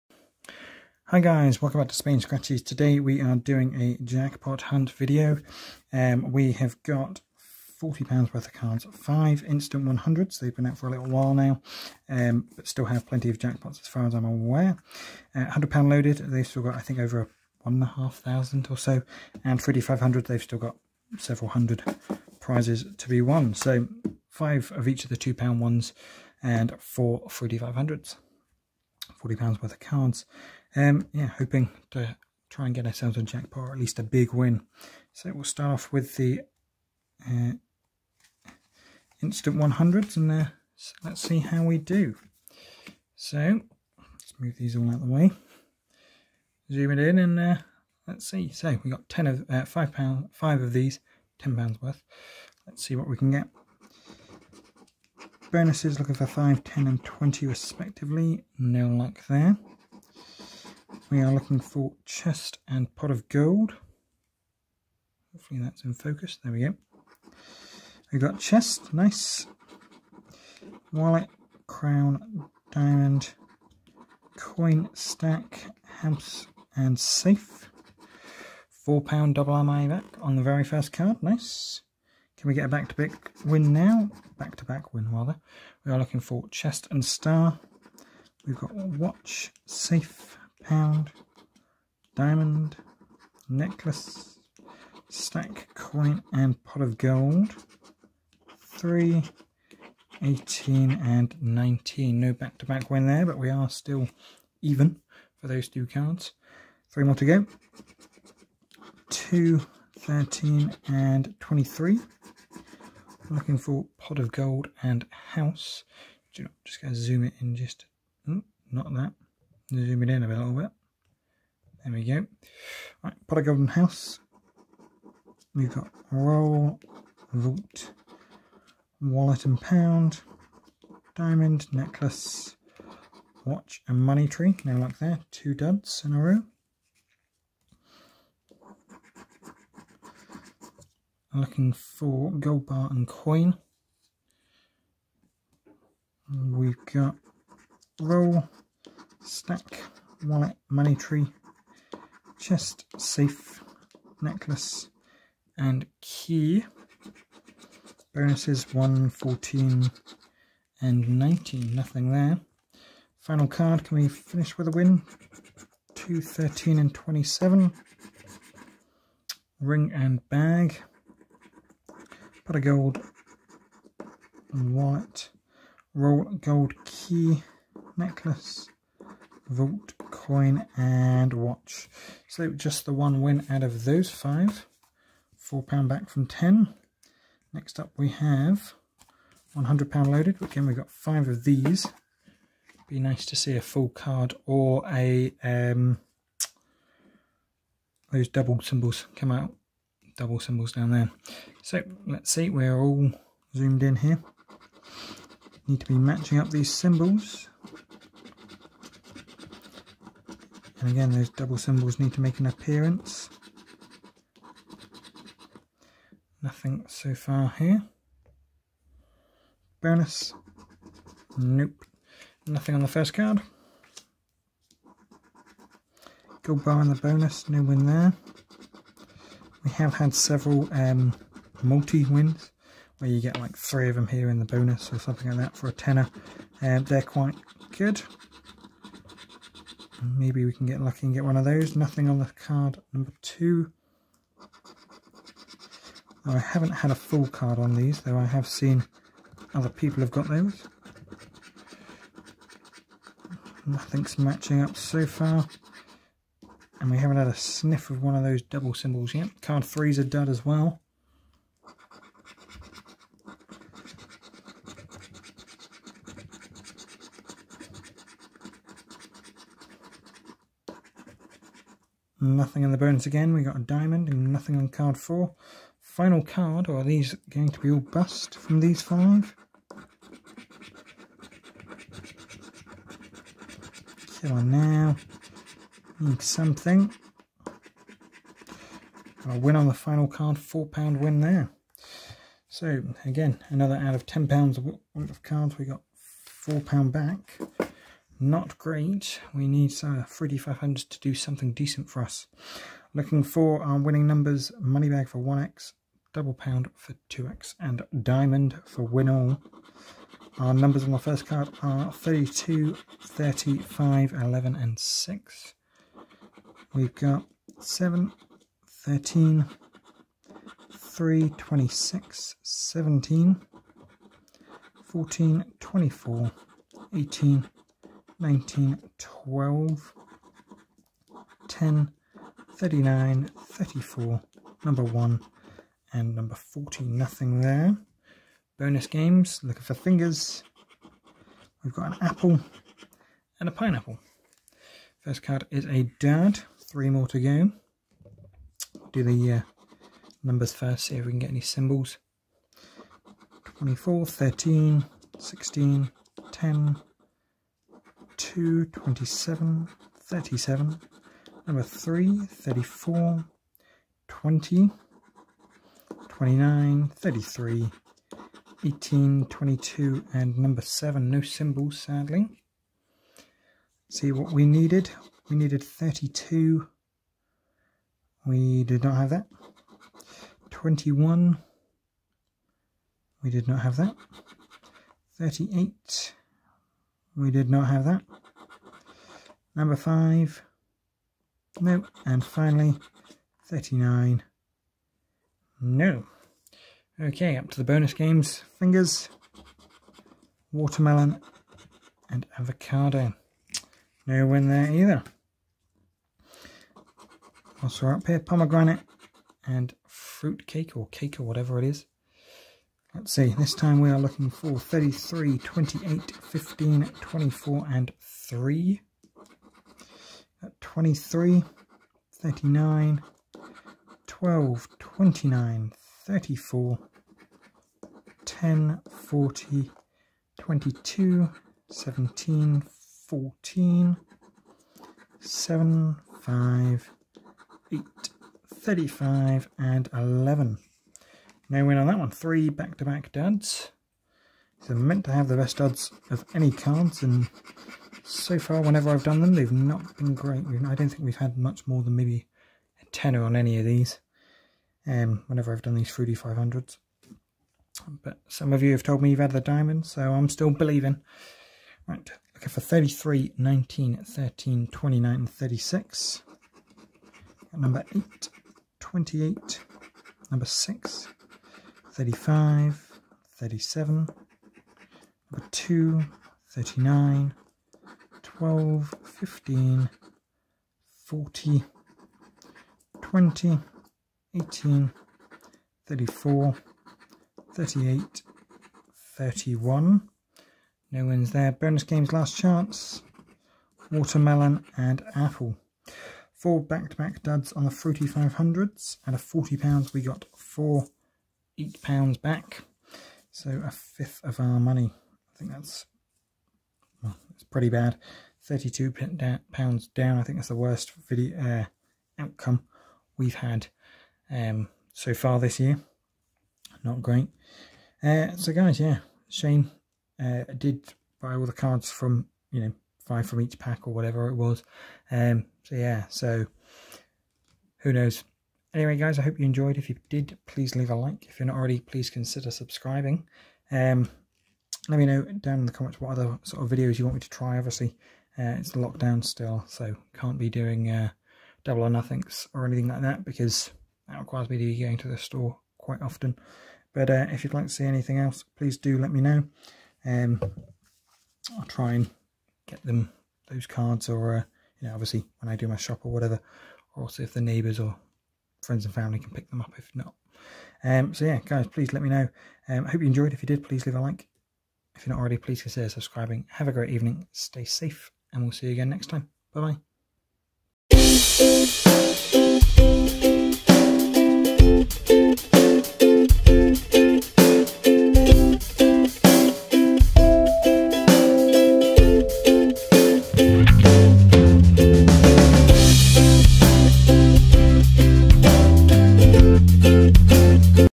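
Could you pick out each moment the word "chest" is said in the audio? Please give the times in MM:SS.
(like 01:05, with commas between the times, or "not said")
01:02, 01:08, 01:26, 02:32.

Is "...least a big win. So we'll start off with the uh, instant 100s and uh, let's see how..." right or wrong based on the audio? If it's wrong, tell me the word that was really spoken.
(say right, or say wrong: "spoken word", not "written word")
right.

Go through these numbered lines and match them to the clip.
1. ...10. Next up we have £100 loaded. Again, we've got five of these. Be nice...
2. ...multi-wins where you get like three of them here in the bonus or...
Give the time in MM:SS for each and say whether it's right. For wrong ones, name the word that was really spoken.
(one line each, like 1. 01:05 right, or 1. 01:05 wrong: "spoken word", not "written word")
1. 03:06 right
2. 03:51 right.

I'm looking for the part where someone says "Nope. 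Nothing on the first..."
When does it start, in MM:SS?
03:41.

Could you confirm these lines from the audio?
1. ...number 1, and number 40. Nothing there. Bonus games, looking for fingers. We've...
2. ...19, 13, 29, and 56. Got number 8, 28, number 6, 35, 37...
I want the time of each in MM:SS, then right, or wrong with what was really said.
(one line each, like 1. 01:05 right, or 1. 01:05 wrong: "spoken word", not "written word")
1. 05:34 right
2. 07:43 wrong: "36", not "56".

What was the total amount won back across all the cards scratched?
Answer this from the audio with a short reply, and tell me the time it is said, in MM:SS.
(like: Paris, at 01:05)
£8, at 08:21.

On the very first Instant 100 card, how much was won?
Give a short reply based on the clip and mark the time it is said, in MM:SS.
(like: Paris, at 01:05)
£4, at 01:18.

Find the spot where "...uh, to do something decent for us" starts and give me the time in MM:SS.
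05:00.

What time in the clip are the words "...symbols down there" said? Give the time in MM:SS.
03:20.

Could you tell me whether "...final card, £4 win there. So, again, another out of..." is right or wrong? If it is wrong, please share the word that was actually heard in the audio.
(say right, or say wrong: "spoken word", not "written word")
right.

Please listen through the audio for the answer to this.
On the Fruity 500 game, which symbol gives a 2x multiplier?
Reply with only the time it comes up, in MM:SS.
05:06.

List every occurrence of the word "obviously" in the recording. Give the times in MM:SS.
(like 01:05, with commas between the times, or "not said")
08:57, 09:14.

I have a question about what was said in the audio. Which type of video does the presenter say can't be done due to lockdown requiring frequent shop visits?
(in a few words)
double or nothings.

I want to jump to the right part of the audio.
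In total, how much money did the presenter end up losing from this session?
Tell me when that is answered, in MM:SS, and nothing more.
08:28.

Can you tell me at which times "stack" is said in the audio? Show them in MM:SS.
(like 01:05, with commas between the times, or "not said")
01:14, 01:35, 02:29.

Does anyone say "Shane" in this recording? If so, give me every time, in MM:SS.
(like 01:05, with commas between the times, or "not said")
08:39.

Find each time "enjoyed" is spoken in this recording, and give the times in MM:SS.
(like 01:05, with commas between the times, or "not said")
08:49, 09:23.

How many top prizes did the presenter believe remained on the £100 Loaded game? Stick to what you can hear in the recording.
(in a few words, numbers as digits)
over 1,500.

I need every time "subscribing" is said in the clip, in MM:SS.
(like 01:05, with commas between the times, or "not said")
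08:52, 09:25.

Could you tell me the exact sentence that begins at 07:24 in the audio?
So are meant to have the best duds of any cards, and so far, whenever I've done them, they've not been great.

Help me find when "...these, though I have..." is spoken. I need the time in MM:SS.
04:07.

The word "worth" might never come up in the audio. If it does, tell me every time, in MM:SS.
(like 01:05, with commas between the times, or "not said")
00:08, 00:29, 00:51, 04:54.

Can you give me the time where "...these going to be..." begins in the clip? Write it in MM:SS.
04:36.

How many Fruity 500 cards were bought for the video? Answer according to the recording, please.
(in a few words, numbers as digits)
4.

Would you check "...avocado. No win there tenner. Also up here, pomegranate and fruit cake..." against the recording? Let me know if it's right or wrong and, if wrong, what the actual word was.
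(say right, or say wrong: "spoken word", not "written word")
wrong: "either", not "tenner".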